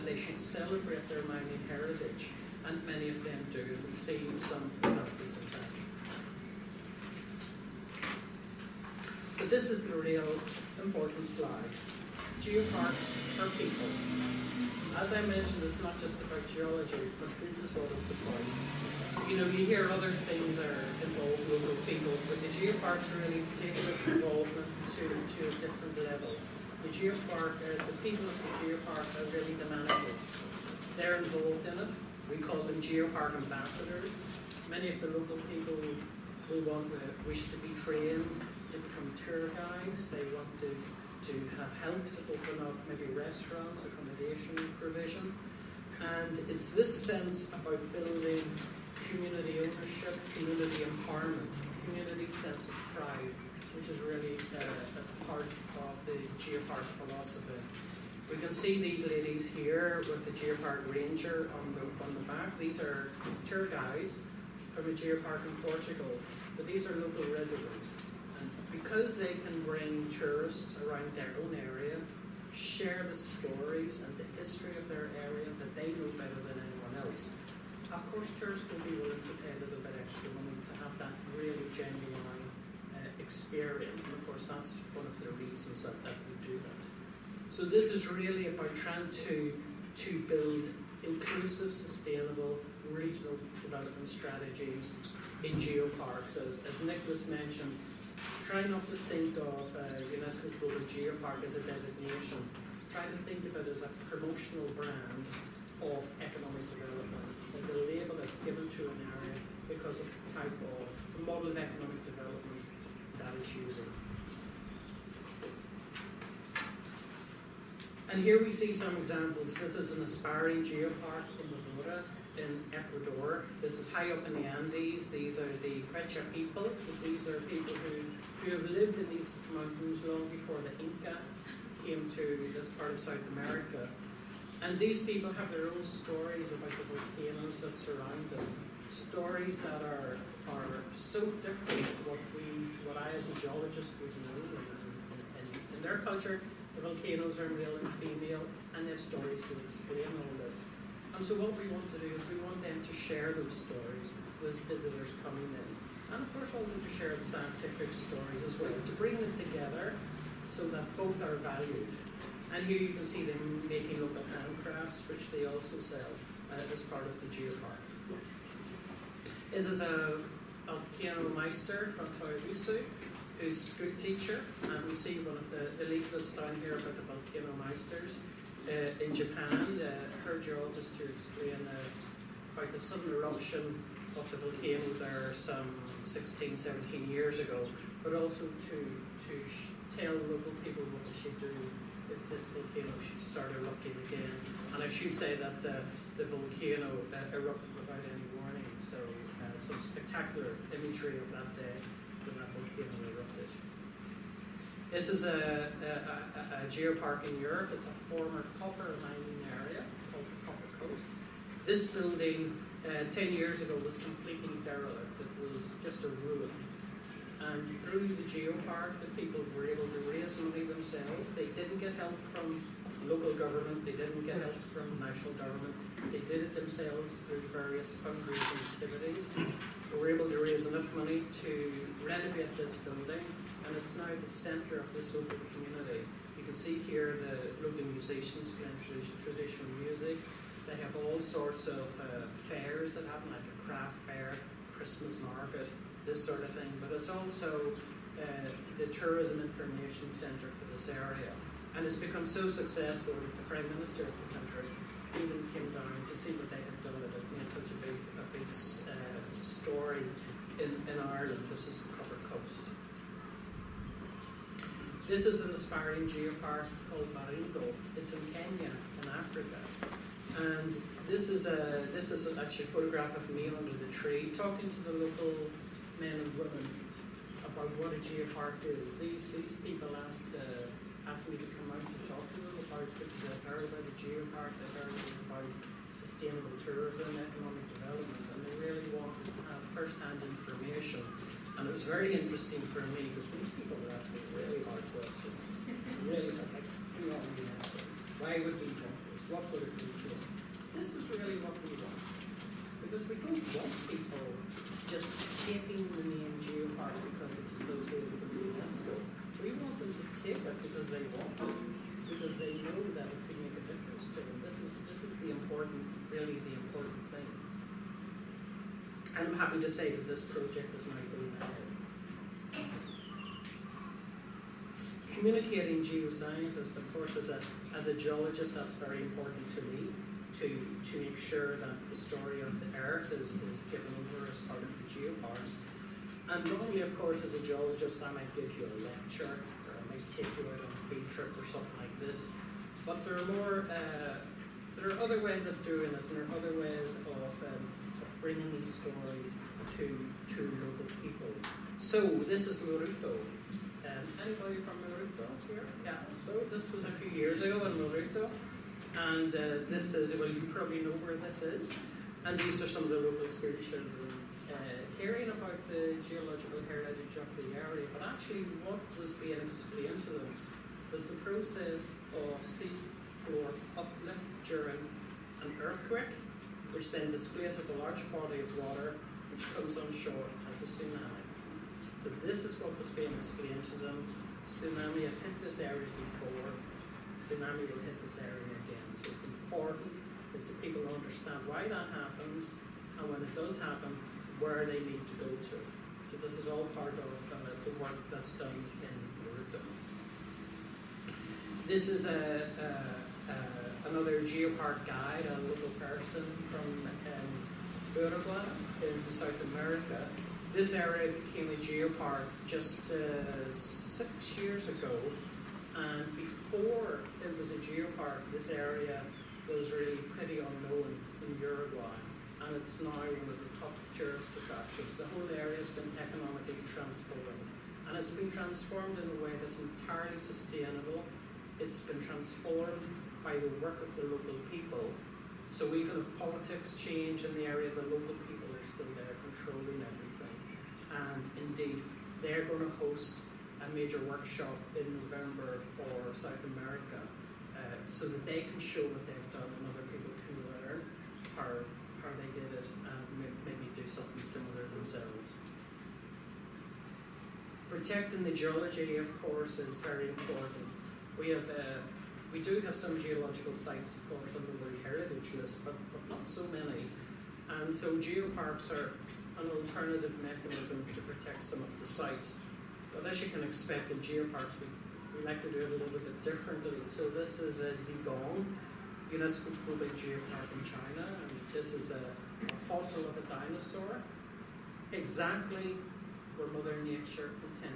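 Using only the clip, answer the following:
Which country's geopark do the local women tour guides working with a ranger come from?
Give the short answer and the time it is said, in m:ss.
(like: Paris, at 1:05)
Portugal, at 1:05.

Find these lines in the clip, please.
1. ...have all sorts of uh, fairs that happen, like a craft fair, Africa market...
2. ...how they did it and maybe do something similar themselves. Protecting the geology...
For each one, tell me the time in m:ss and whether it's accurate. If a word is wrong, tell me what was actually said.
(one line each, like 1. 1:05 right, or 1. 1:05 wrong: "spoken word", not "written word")
1. 4:00 wrong: "Christmas", not "Africa"
2. 7:32 right.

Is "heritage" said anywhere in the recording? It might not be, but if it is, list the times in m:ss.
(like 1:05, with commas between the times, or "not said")
0:01, 6:06, 7:44.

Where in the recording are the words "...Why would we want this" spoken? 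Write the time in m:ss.
4:58.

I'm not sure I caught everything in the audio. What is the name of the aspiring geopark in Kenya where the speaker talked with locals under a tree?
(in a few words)
Baringo.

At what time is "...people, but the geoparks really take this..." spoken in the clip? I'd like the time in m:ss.
0:21.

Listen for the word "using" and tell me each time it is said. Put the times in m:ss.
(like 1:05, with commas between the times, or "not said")
1:53.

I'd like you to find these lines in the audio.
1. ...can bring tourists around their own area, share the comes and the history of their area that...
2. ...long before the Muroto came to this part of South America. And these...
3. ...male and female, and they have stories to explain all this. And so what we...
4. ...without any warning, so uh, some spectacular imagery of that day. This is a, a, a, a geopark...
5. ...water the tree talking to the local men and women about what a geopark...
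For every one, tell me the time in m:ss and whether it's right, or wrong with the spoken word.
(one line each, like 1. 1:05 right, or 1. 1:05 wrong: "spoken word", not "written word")
1. 1:09 wrong: "stories", not "comes"
2. 2:10 wrong: "Inca", not "Muroto"
3. 2:27 right
4. 3:17 right
5. 4:33 wrong: "under", not "water".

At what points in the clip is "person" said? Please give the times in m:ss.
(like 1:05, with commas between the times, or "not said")
6:45.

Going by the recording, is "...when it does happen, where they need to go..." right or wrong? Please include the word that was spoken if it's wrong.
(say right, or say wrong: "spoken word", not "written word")
right.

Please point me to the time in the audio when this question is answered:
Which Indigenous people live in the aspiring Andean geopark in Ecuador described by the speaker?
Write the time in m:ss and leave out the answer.
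2:05.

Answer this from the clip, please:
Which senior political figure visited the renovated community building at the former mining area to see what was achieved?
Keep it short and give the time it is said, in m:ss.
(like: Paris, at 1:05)
The Prime Minister, at 4:13.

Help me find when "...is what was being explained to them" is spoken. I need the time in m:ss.
6:22.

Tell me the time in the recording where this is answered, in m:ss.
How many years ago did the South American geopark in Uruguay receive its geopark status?
6:53.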